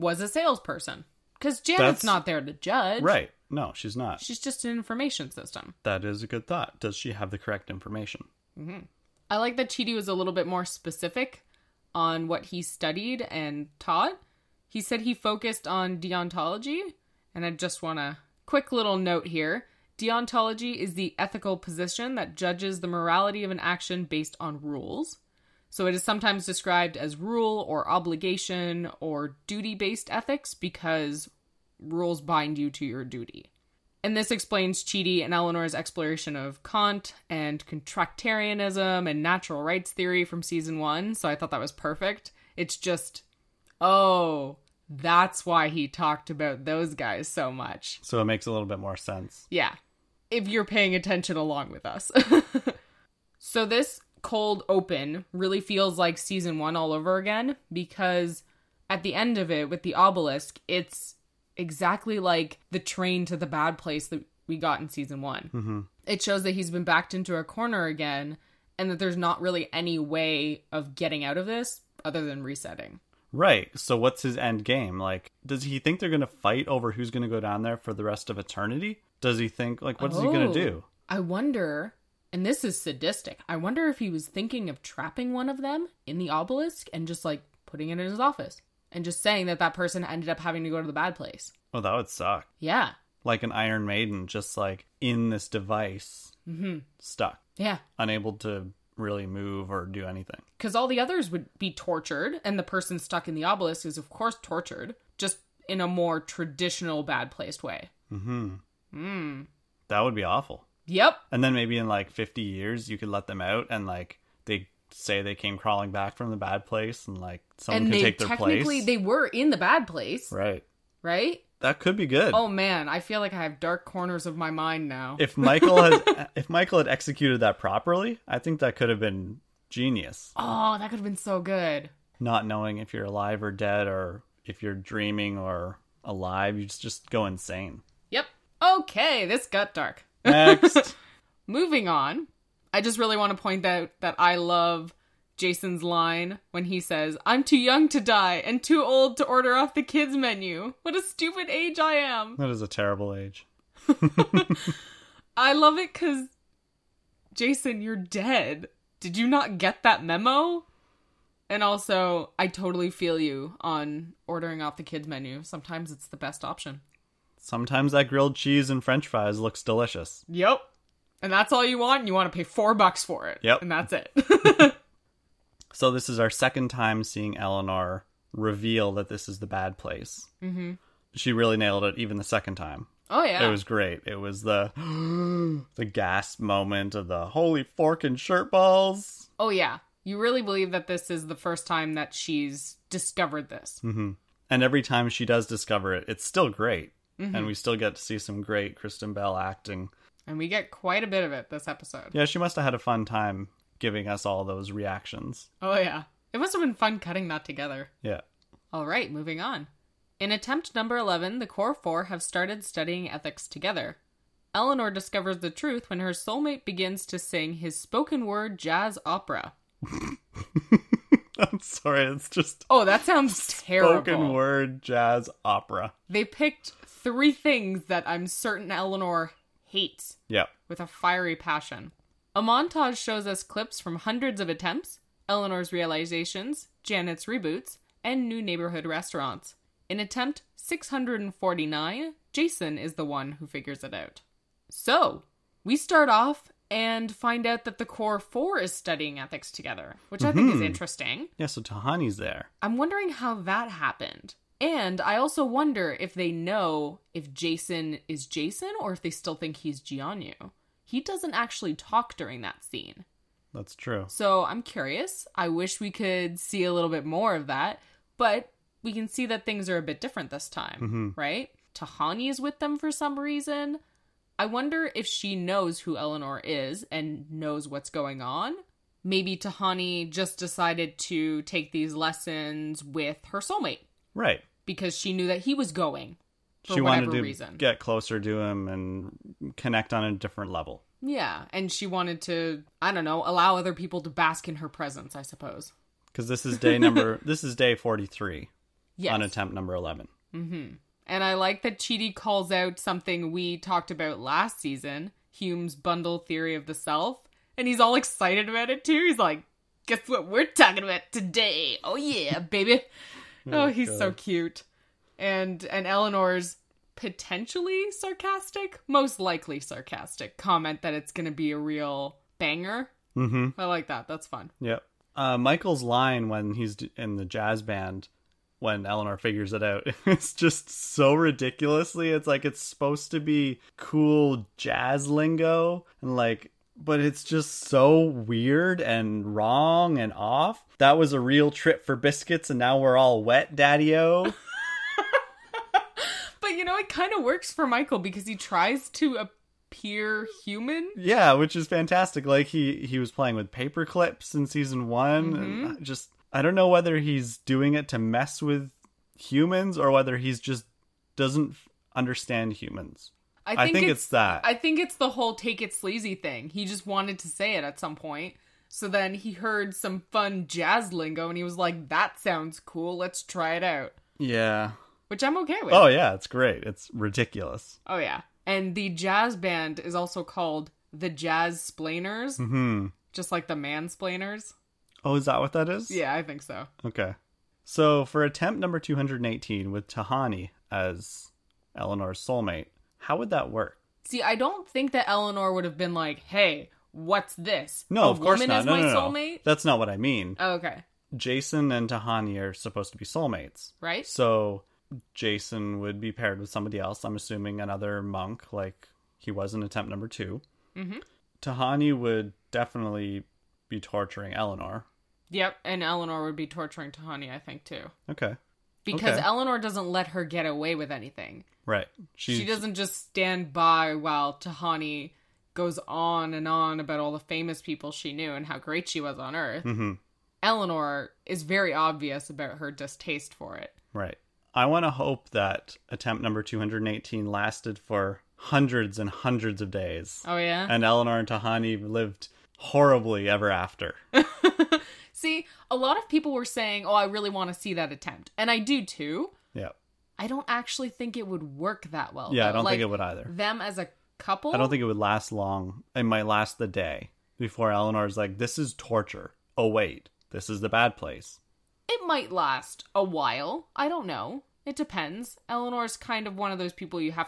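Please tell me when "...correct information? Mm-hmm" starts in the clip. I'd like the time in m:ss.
0:07.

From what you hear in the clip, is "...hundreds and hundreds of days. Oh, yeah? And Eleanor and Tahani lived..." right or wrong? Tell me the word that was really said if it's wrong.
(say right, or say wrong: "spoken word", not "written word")
right.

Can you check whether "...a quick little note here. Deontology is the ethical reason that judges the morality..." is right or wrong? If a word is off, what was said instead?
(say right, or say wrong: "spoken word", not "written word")
wrong: "position", not "reason".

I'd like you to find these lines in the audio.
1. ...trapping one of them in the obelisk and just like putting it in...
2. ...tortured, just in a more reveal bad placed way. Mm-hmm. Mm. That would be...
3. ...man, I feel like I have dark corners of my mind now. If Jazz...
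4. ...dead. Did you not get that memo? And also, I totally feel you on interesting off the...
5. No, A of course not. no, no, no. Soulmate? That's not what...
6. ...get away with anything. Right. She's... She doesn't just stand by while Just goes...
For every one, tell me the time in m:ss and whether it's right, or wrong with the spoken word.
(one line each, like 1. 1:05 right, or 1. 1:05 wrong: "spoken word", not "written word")
1. 1:24 right
2. 1:44 wrong: "traditional", not "reveal"
3. 2:02 wrong: "Michael", not "Jazz"
4. 2:37 wrong: "ordering", not "interesting"
5. 6:37 right
6. 7:00 wrong: "Tahani", not "Just".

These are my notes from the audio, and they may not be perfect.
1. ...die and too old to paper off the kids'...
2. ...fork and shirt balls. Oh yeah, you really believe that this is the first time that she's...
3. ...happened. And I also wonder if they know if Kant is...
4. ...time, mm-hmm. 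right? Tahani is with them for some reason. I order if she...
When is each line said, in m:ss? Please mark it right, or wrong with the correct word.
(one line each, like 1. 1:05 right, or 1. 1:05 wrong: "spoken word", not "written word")
1. 2:28 wrong: "order", not "paper"
2. 3:07 right
3. 4:13 wrong: "Jason", not "Kant"
4. 4:30 wrong: "wonder", not "order".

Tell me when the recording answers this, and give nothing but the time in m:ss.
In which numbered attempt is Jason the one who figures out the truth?
4:00.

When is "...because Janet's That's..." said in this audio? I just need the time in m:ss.
0:01.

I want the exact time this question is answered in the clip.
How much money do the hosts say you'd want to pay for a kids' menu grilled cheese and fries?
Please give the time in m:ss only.
2:52.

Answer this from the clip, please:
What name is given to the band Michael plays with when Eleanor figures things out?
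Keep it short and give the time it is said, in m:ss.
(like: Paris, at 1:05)
the Jazz Splainers, at 6:21.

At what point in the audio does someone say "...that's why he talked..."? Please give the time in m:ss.
0:44.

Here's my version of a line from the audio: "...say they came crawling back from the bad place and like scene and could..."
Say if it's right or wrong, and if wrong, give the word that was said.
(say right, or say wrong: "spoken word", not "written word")
wrong: "someone", not "scene".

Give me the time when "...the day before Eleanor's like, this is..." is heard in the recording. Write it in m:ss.
7:36.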